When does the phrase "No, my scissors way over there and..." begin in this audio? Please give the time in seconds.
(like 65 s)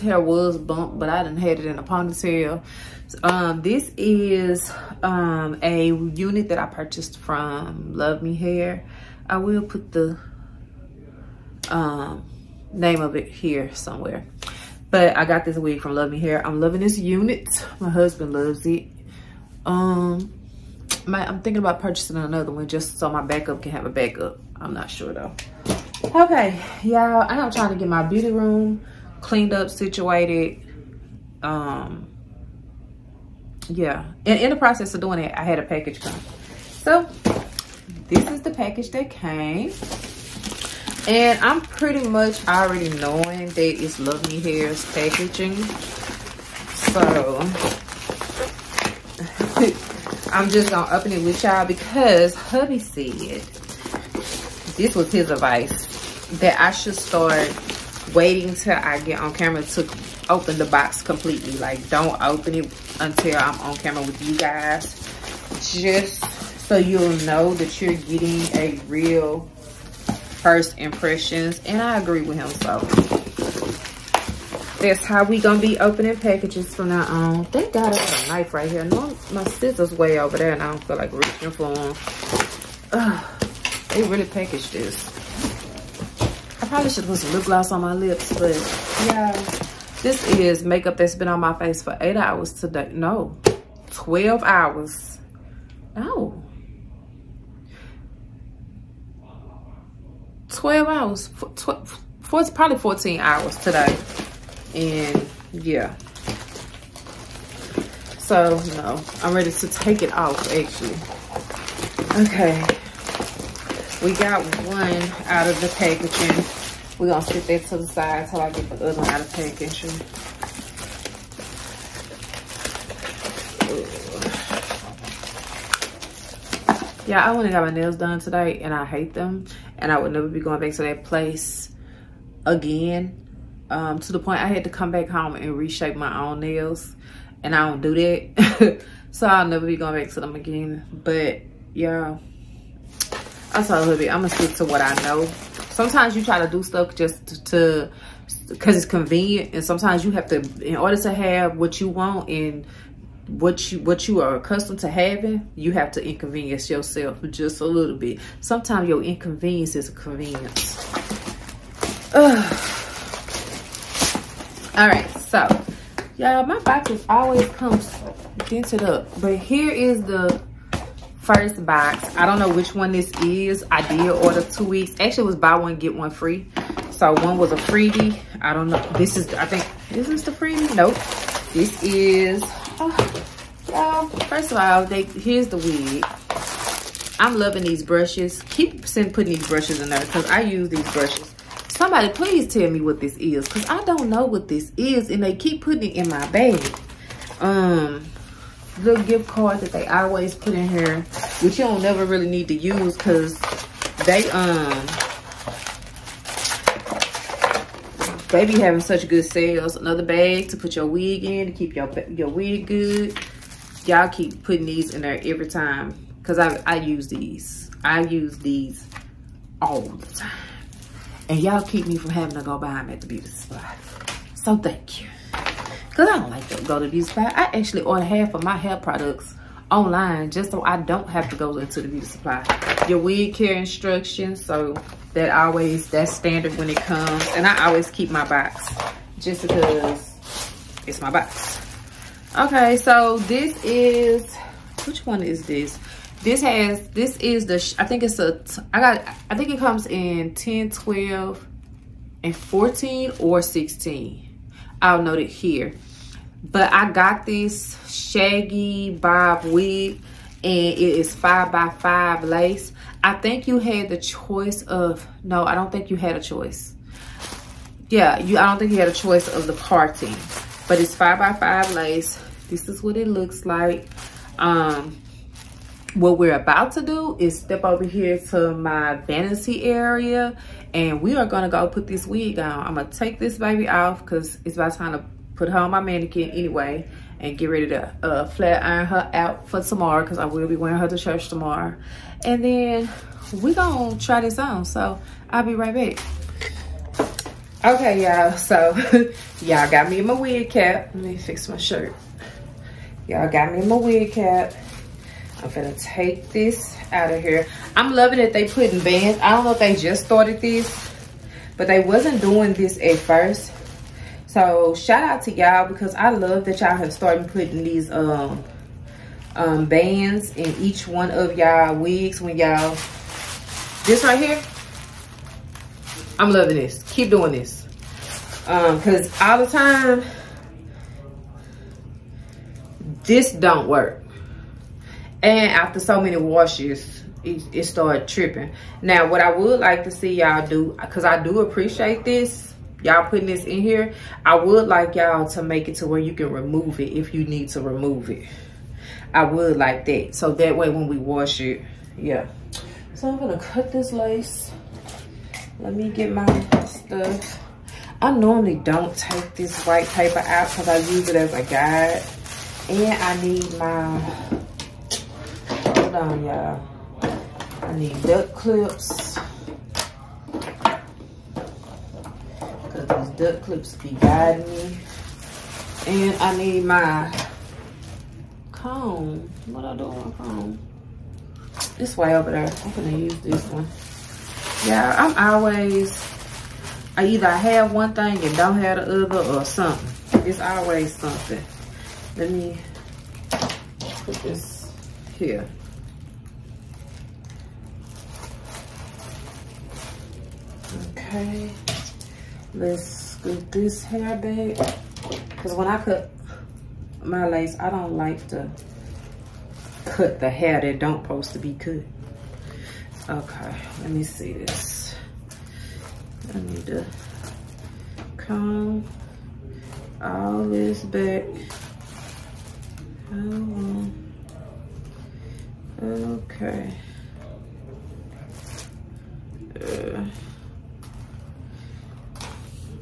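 78 s.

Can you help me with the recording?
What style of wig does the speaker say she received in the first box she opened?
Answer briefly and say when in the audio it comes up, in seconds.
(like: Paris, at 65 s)
shaggy bob, at 257 s.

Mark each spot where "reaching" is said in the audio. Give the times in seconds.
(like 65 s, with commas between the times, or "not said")
81 s.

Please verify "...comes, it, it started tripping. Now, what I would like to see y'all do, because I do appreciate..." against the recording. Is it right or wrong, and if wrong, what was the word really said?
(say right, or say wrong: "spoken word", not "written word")
wrong: "washes", not "comes".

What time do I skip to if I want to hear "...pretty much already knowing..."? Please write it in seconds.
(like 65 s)
41 s.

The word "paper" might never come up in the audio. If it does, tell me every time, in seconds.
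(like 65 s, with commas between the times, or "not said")
359 s.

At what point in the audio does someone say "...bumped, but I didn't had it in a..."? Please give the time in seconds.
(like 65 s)
0 s.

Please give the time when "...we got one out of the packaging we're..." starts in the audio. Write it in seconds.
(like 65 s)
114 s.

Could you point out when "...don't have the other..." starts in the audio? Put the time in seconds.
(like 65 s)
388 s.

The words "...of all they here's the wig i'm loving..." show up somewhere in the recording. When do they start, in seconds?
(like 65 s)
184 s.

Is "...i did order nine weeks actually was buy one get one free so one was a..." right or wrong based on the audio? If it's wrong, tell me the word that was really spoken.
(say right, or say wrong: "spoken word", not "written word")
wrong: "two", not "nine".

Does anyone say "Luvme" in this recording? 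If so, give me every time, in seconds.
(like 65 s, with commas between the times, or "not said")
7 s, 15 s, 43 s.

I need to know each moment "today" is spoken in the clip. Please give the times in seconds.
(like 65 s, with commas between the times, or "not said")
92 s, 103 s, 128 s.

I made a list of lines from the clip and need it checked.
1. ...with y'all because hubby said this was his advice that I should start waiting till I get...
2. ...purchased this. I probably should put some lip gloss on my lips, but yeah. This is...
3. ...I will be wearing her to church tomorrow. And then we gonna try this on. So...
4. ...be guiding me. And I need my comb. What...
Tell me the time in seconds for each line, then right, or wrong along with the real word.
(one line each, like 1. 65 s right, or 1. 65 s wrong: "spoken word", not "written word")
1. 51 s right
2. 84 s wrong: "packaged", not "purchased"
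3. 290 s right
4. 373 s right.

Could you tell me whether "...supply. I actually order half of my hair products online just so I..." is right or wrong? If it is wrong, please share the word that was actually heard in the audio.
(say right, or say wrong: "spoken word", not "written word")
right.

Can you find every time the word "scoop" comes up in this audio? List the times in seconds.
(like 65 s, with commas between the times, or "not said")
402 s.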